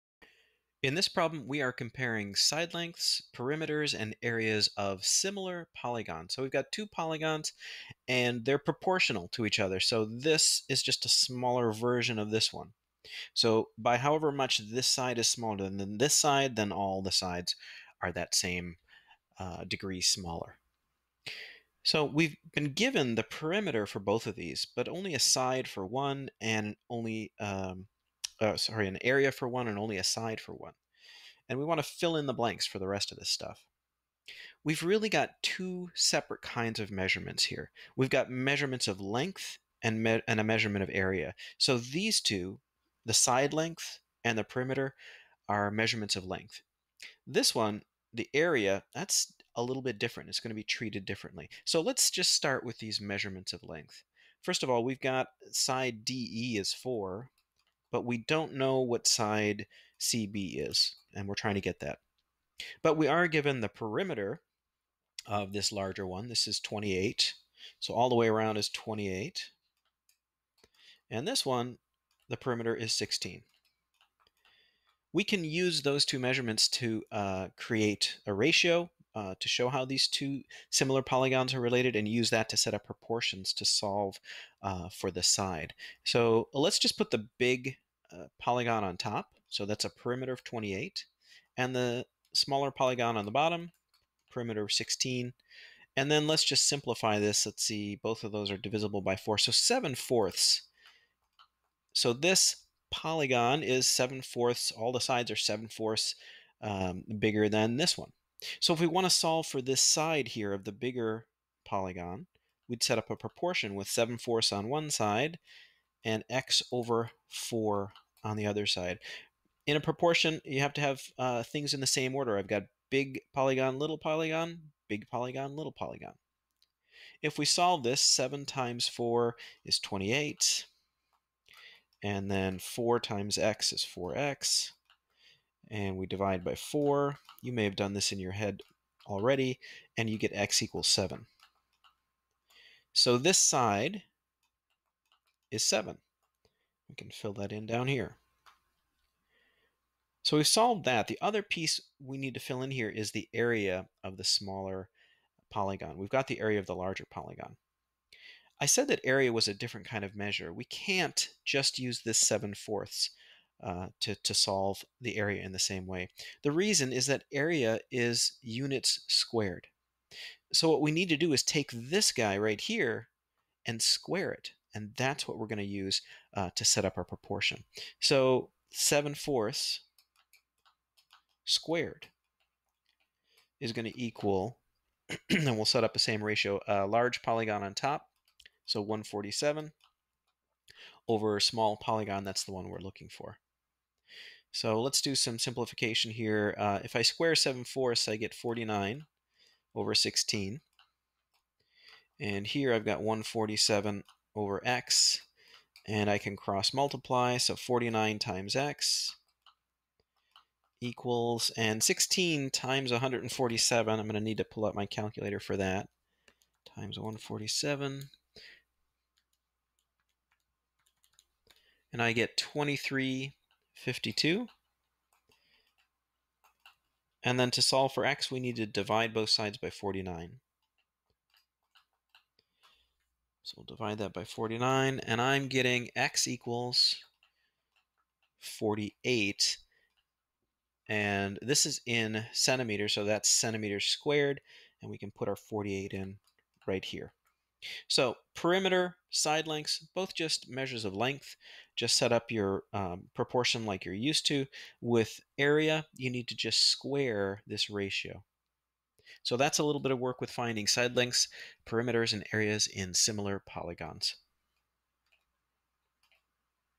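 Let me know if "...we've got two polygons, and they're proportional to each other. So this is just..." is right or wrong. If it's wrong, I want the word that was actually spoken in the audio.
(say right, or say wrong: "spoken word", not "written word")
right.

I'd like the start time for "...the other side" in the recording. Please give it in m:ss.
1:58.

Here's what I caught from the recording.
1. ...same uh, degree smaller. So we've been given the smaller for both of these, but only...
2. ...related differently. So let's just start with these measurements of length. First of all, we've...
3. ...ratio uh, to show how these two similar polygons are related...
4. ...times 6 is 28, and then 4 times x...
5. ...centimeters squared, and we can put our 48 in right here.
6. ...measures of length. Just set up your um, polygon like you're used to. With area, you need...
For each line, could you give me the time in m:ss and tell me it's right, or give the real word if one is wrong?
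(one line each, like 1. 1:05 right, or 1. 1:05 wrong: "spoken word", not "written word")
1. 0:18 wrong: "perimeter", not "smaller"
2. 0:50 wrong: "treated", not "related"
3. 1:18 right
4. 2:08 wrong: "4", not "6"
5. 4:03 right
6. 4:10 wrong: "proportion", not "polygon".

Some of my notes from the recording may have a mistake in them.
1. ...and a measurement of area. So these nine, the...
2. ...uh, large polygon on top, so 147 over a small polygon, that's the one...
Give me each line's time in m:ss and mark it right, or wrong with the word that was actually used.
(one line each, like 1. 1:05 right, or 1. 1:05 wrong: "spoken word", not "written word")
1. 0:40 wrong: "two", not "nine"
2. 3:06 right.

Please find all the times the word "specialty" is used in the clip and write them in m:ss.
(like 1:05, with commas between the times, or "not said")
not said.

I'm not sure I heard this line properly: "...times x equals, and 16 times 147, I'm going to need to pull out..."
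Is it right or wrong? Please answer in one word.
right.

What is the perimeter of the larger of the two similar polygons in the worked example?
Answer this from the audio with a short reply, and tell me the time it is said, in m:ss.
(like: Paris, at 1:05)
28, at 1:06.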